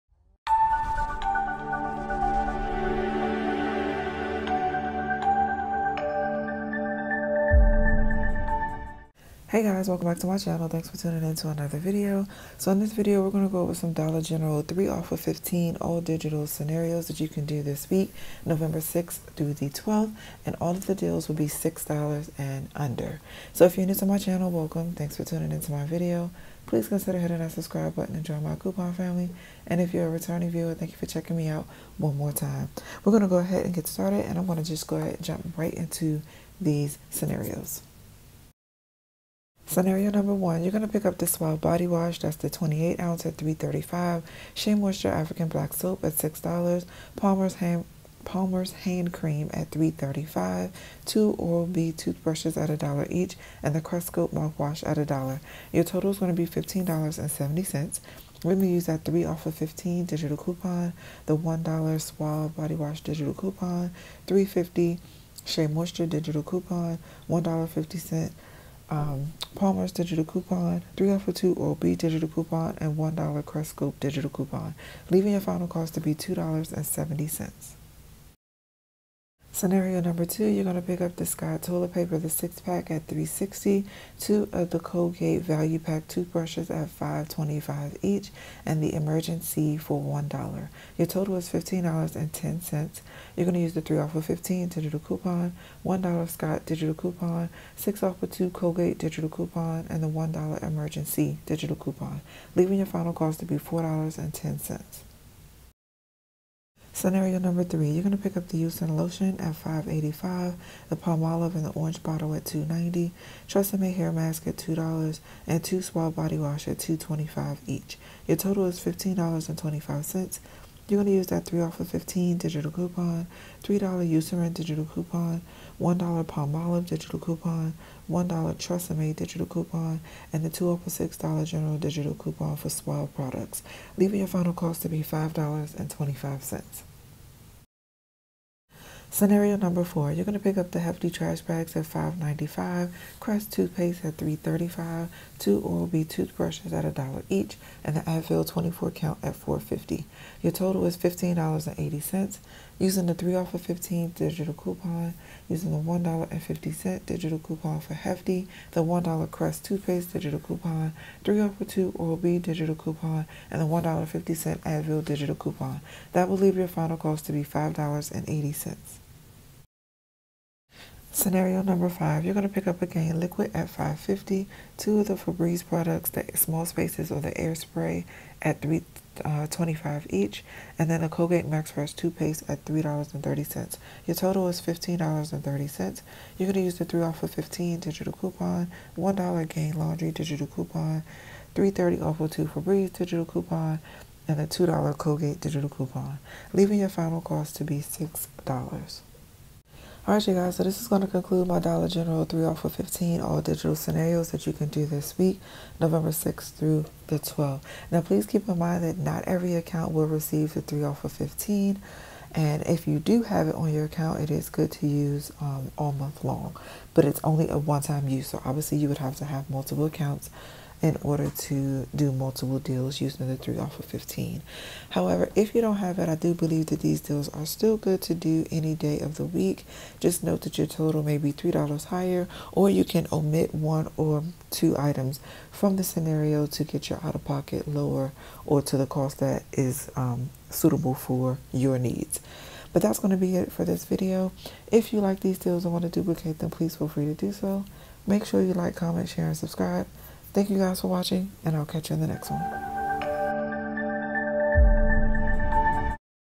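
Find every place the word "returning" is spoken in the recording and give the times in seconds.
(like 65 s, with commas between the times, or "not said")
30 s.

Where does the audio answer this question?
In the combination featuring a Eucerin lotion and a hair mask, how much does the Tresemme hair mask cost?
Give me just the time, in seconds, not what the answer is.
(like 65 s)
113 s.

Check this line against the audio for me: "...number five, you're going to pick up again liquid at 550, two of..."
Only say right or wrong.
right.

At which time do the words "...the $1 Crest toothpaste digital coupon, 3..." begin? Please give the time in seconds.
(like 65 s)
158 s.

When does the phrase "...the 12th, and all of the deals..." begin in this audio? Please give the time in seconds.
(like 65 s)
19 s.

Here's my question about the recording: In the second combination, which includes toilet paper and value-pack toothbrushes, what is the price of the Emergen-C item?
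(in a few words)
$1.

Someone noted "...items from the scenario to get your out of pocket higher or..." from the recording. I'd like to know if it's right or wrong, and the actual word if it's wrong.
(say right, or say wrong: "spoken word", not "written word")
wrong: "lower", not "higher".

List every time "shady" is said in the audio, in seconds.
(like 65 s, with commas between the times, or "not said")
not said.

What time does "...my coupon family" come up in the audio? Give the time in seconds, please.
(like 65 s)
28 s.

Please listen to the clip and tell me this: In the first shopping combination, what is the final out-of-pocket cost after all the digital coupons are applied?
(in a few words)
$2.70.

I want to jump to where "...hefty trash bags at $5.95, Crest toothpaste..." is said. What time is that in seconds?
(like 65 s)
140 s.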